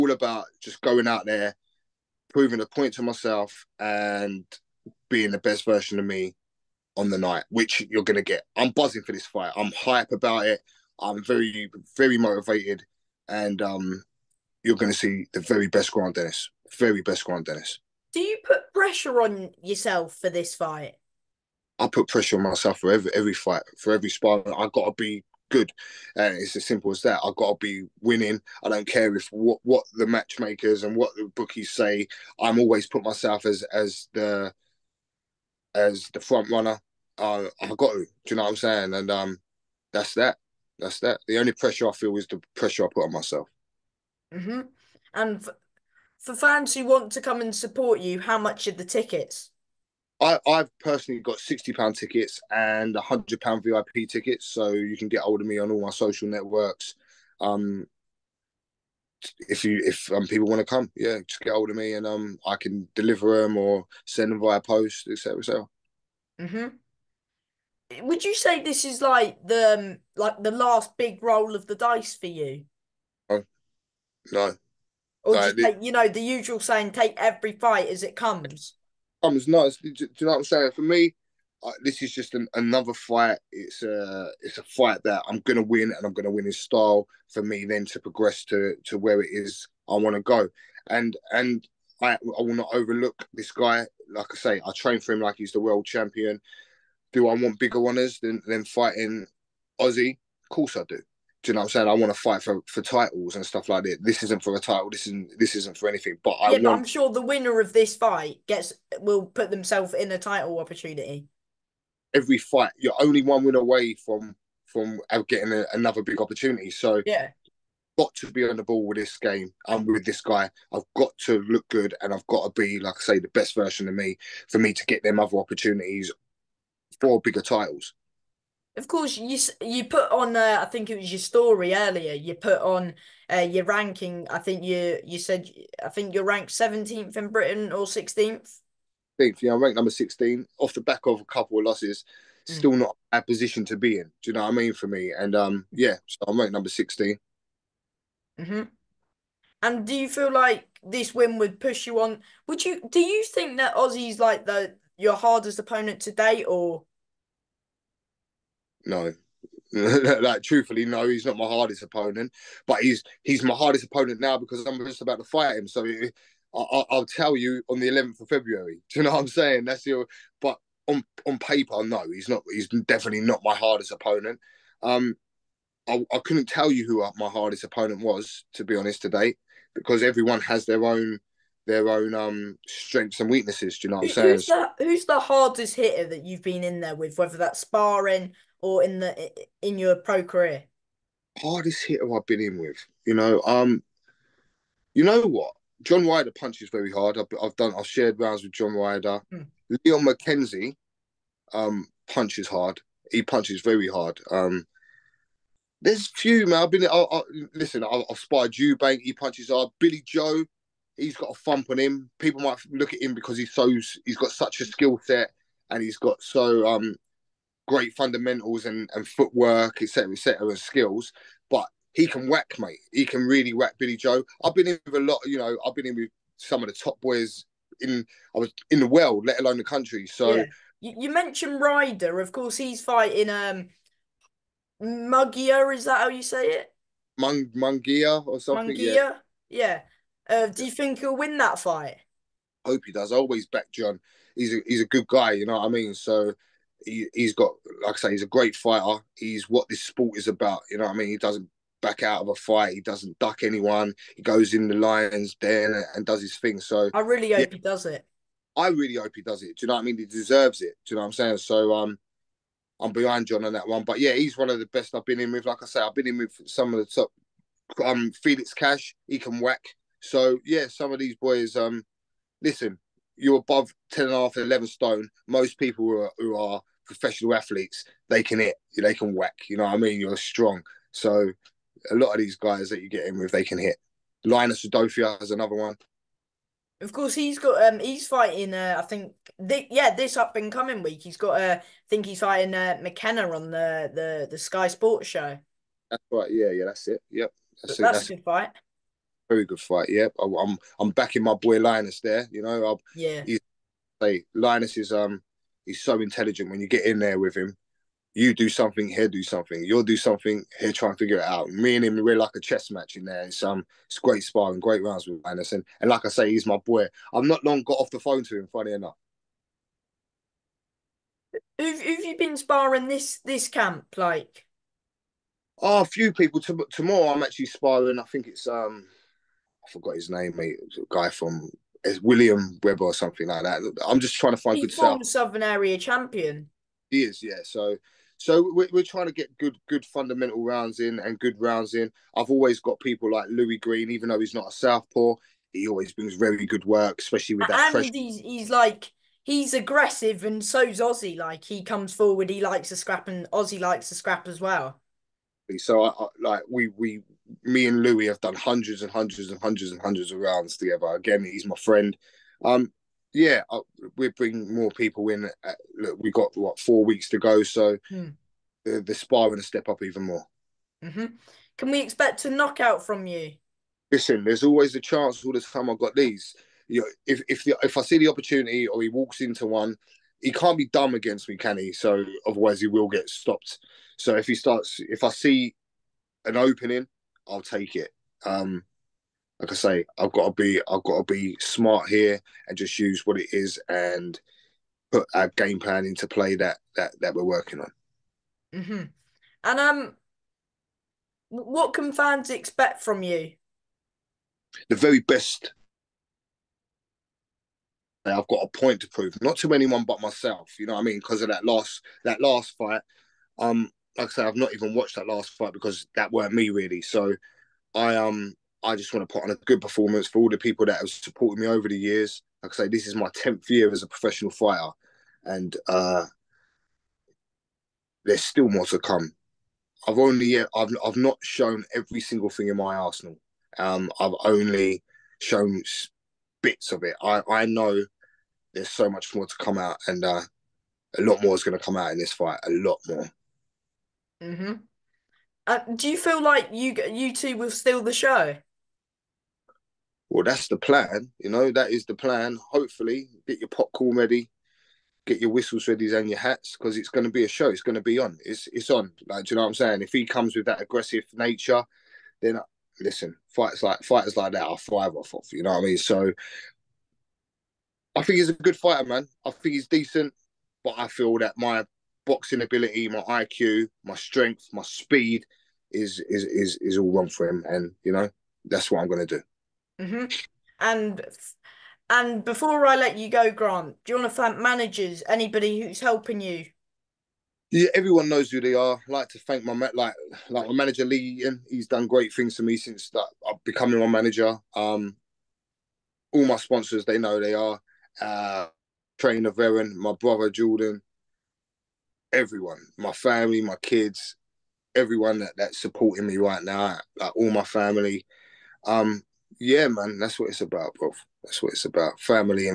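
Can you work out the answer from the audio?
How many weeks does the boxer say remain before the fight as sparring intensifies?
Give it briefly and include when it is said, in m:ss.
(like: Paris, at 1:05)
4, at 6:06.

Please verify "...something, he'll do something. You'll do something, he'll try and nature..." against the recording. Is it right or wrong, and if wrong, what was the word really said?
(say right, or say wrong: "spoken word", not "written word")
wrong: "figure", not "nature".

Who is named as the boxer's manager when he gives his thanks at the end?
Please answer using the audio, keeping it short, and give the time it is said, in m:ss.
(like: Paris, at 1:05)
Lee Eaton, at 8:10.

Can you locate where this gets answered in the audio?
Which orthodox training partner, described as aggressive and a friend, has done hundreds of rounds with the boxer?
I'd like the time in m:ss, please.
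5:43.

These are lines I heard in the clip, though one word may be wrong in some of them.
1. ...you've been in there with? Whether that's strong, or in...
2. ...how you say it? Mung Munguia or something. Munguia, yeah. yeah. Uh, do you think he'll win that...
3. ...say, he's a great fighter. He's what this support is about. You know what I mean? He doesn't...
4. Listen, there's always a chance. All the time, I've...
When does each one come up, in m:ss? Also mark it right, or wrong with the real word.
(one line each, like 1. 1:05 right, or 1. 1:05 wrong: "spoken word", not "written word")
1. 3:06 wrong: "sparring", not "strong"
2. 3:55 right
3. 4:07 wrong: "sport", not "support"
4. 6:13 right.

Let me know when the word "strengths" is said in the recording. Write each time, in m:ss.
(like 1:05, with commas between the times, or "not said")
3:02, 7:53.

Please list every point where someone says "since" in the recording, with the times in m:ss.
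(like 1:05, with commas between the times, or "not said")
8:12.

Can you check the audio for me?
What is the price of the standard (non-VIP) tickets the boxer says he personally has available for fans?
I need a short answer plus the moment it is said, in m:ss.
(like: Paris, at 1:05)
£60, at 0:51.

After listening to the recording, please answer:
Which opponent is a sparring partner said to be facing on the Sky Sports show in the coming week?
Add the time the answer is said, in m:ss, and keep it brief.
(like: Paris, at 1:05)
McKenna, at 4:52.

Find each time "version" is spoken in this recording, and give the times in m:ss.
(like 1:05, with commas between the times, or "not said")
0:05, 2:03.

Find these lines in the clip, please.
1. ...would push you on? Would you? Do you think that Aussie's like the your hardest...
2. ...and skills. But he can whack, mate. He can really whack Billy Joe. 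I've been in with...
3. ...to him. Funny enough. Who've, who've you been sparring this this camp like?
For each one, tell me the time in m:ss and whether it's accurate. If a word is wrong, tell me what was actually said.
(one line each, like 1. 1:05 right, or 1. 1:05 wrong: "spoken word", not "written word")
1. 2:31 right
2. 3:40 right
3. 5:18 right.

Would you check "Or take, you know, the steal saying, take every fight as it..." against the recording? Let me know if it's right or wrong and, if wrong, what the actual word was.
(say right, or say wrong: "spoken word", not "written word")
wrong: "usual", not "steal".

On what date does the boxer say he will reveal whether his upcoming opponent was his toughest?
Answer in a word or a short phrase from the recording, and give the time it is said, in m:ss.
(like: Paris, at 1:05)
11th of February, at 2:47.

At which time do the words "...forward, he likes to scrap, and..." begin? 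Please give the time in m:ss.
5:51.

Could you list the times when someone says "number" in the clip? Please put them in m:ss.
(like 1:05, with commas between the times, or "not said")
2:19, 2:26.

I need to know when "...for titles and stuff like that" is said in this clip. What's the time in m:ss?
1:42.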